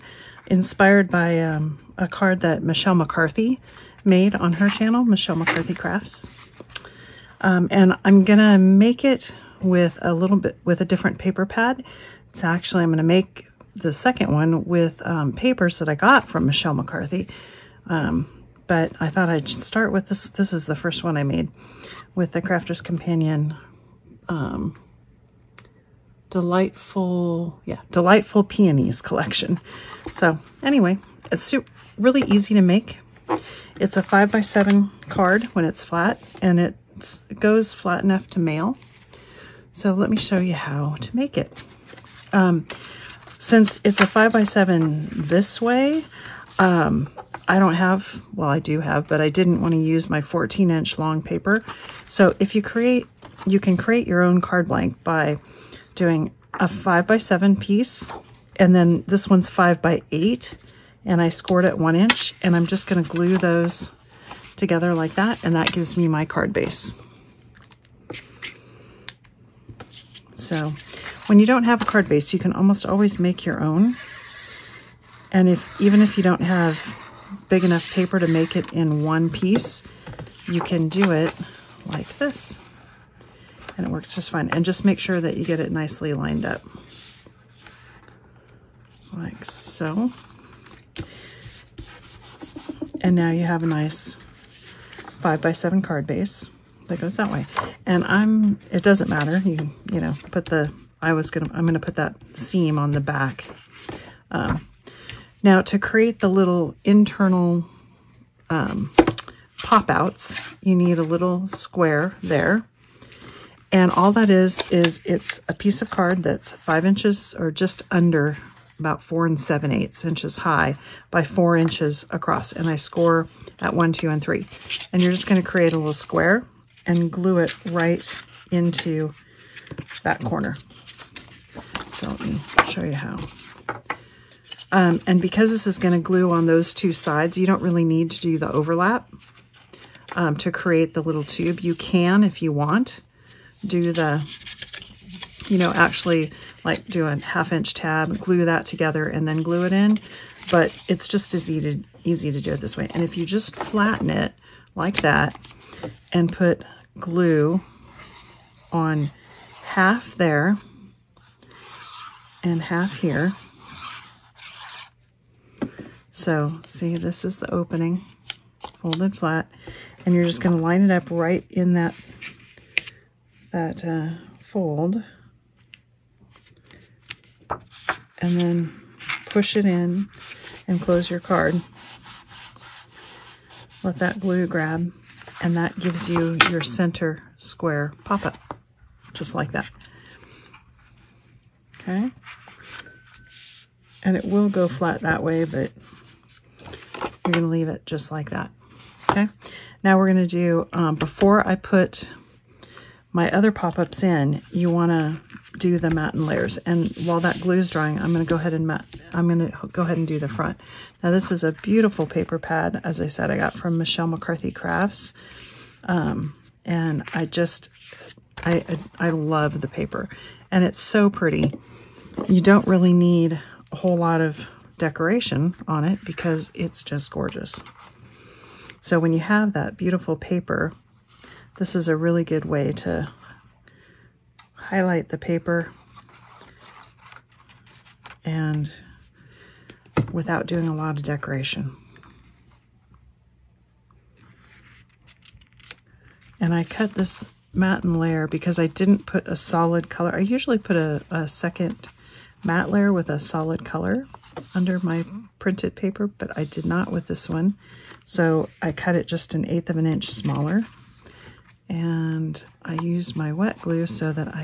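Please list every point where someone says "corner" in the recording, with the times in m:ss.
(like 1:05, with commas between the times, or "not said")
2:10.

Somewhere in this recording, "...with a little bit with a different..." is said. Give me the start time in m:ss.
0:09.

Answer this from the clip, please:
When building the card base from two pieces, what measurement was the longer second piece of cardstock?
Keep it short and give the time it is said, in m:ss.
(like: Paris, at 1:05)
5 by 8, at 0:59.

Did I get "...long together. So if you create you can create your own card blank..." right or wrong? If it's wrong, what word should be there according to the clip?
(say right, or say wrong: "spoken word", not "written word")
wrong: "paper", not "together".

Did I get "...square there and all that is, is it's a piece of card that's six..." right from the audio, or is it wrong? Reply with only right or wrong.
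wrong.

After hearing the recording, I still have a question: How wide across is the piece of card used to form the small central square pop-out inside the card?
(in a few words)
4 inches.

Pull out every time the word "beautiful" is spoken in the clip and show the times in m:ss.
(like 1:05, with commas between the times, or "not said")
3:31, 3:49.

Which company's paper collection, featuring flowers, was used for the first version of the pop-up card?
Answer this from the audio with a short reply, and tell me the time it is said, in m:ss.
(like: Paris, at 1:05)
Crafter's Companion, at 0:22.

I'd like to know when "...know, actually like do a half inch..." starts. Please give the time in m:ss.
2:25.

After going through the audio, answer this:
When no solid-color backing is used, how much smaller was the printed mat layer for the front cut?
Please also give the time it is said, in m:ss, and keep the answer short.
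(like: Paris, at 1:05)
1/8 inch, at 4:19.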